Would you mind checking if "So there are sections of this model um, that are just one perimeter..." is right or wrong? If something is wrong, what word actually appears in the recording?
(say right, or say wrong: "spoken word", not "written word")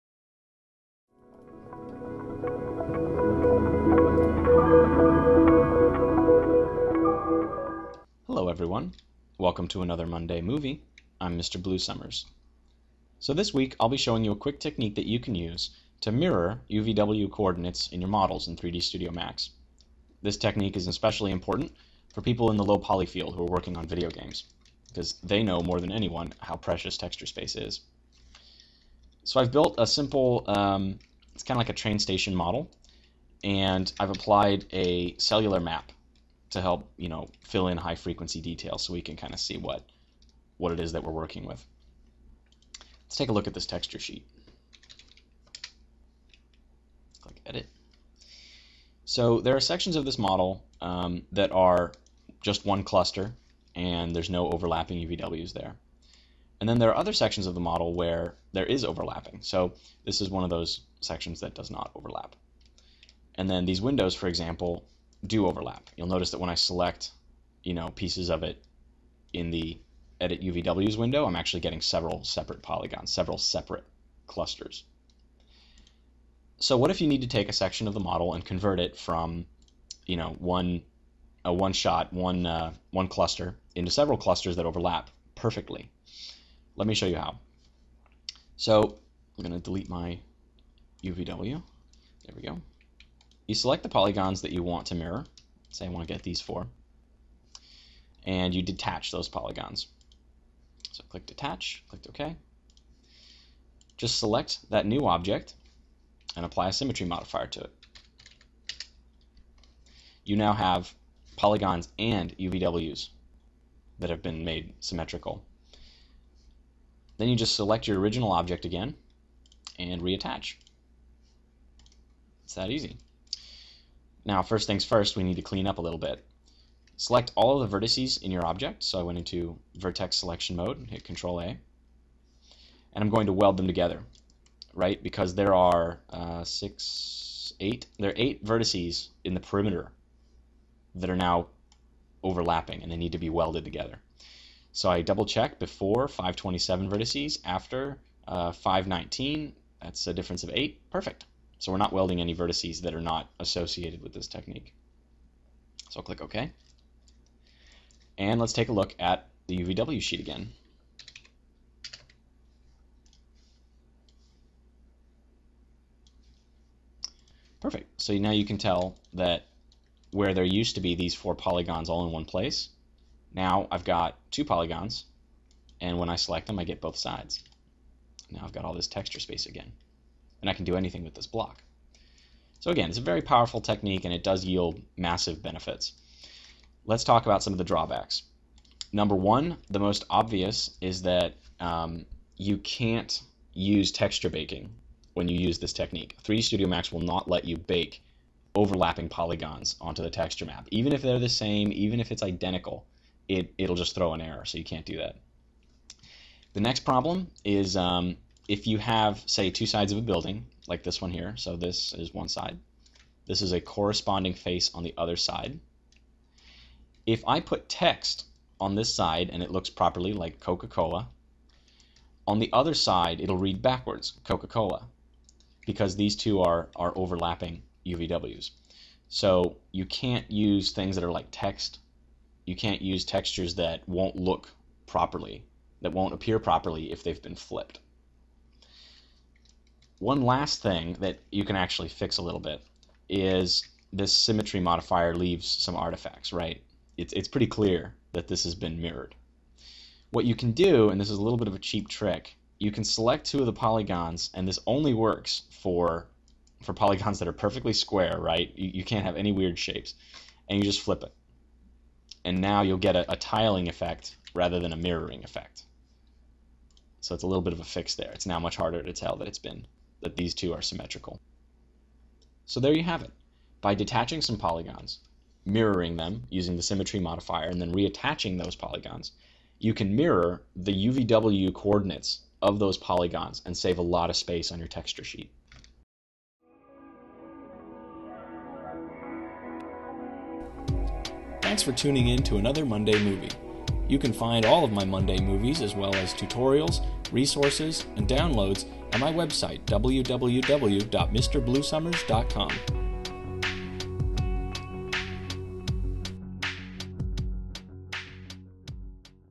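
wrong: "cluster", not "perimeter".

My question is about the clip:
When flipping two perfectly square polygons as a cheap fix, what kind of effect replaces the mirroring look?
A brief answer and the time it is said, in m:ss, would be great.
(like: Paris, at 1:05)
tiling effect, at 4:23.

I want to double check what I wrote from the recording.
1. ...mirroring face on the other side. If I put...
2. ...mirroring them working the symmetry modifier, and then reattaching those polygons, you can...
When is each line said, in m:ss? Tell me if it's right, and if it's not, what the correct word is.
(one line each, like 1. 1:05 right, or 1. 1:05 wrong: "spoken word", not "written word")
1. 3:33 wrong: "corresponding", not "mirroring"
2. 4:35 wrong: "using", not "working".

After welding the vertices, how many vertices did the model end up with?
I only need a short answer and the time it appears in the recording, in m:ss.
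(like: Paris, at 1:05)
519, at 2:28.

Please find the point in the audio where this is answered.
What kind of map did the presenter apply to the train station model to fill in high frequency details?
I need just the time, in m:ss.
0:35.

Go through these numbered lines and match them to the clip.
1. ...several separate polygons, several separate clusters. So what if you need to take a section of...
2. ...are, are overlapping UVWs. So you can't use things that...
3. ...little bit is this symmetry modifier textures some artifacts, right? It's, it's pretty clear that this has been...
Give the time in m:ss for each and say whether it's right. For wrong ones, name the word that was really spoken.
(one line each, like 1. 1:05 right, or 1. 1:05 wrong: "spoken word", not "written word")
1. 1:11 right
2. 3:46 right
3. 4:02 wrong: "leaves", not "textures".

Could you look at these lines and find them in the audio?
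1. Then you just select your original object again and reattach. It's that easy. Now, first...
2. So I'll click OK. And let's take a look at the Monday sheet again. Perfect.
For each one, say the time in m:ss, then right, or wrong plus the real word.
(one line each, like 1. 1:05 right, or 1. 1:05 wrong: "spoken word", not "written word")
1. 1:57 right
2. 2:35 wrong: "UVW", not "Monday".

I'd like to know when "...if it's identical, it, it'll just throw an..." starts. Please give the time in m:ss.
3:21.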